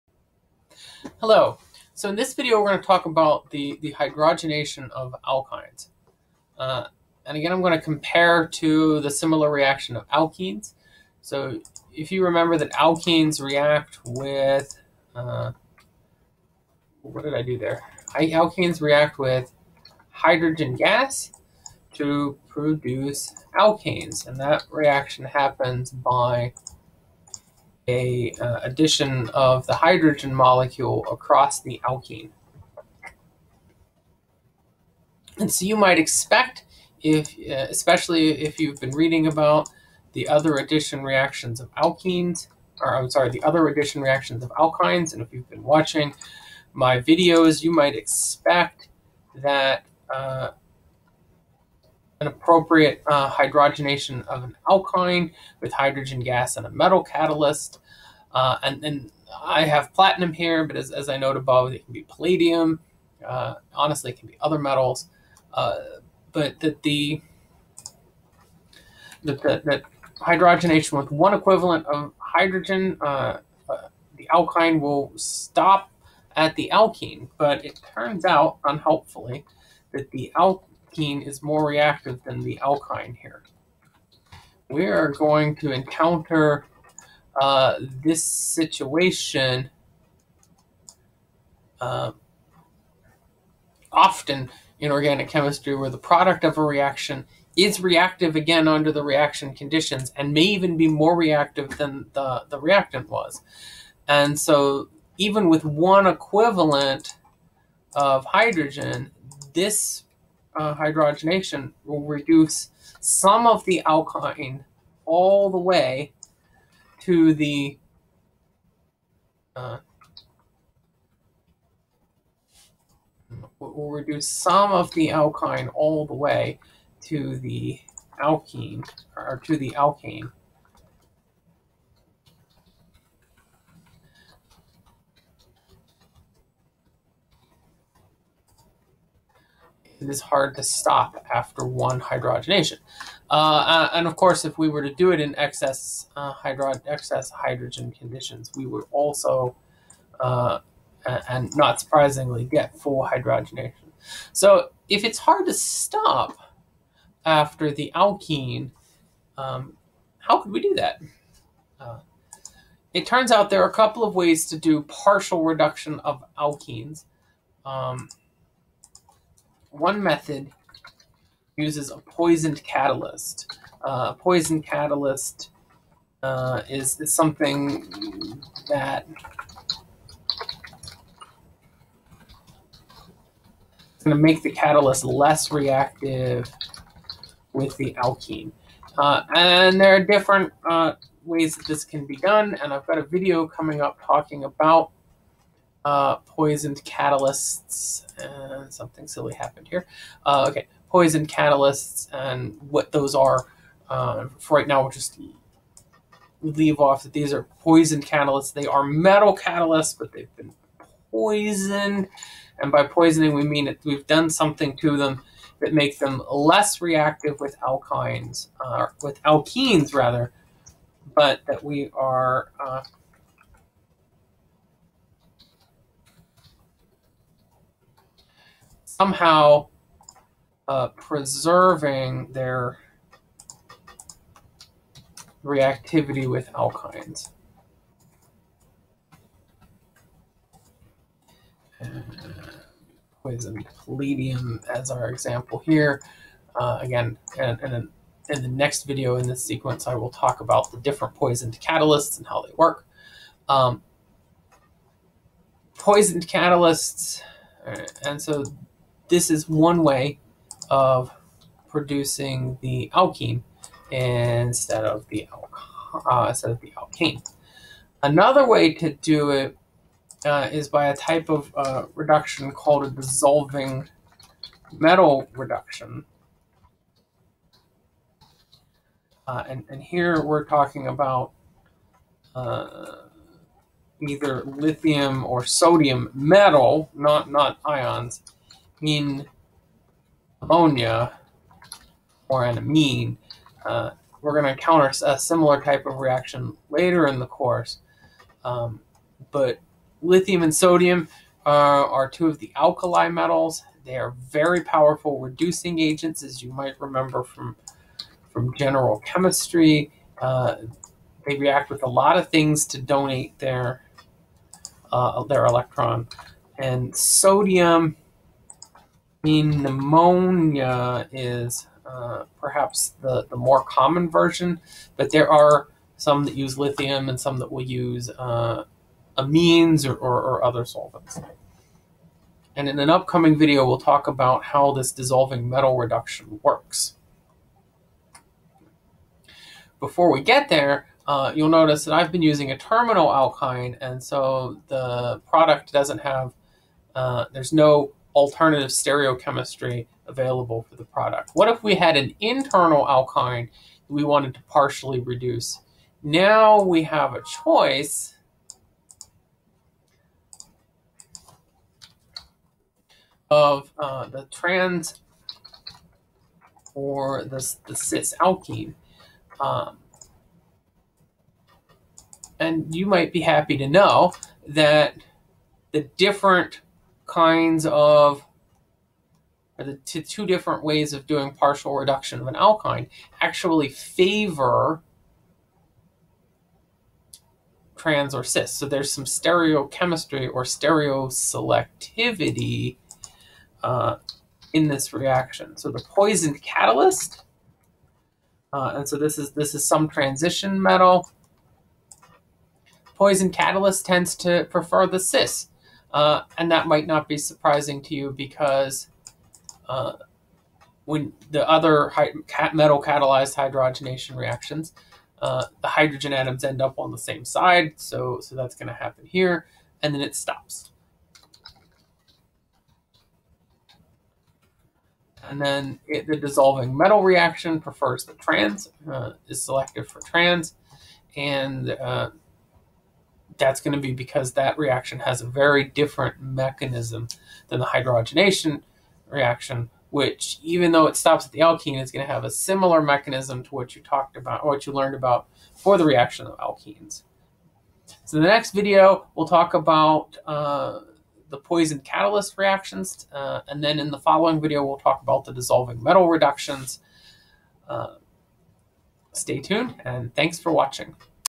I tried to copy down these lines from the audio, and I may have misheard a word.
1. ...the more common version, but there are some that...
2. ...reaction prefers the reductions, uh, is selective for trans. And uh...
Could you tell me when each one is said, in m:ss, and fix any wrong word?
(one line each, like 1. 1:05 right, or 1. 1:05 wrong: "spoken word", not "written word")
1. 5:23 right
2. 7:07 wrong: "trans", not "reductions".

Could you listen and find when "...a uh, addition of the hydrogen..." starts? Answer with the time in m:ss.
0:27.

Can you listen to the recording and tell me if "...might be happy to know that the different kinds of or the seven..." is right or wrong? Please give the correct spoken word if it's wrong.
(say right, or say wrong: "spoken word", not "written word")
wrong: "two", not "seven".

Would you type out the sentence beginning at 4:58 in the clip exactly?
Um, but lithium and sodium are, uh, are two of the alkali metals.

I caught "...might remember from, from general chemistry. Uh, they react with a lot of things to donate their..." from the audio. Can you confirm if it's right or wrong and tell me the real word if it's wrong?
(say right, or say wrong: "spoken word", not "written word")
right.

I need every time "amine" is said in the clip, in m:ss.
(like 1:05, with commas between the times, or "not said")
4:52, 5:29.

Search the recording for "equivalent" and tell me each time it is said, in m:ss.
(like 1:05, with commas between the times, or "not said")
1:11, 1:46.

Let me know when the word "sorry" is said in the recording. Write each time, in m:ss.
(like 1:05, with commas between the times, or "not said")
0:43.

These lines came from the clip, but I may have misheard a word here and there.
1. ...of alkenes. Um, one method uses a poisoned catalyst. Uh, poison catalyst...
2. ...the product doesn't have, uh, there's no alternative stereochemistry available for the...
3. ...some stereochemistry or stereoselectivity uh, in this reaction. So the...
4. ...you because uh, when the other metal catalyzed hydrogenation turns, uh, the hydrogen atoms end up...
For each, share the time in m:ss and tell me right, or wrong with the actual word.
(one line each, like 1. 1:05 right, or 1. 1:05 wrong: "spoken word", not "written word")
1. 2:46 right
2. 5:44 right
3. 6:28 right
4. 6:47 wrong: "reactions", not "turns".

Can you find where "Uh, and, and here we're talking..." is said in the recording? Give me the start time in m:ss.
4:39.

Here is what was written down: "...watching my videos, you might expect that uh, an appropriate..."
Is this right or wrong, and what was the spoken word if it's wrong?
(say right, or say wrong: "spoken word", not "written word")
right.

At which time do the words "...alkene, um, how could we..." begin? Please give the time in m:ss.
2:37.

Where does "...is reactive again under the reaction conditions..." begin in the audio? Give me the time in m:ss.
1:37.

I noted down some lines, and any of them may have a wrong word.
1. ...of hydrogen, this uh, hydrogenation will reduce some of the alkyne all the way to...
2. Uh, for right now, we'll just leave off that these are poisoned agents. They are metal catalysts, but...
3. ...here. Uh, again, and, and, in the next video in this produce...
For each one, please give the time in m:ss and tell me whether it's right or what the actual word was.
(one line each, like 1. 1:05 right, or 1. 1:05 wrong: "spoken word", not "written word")
1. 1:47 right
2. 3:23 wrong: "catalysts", not "agents"
3. 4:05 wrong: "sequence", not "produce".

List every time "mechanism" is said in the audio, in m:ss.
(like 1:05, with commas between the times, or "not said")
7:16, 7:22.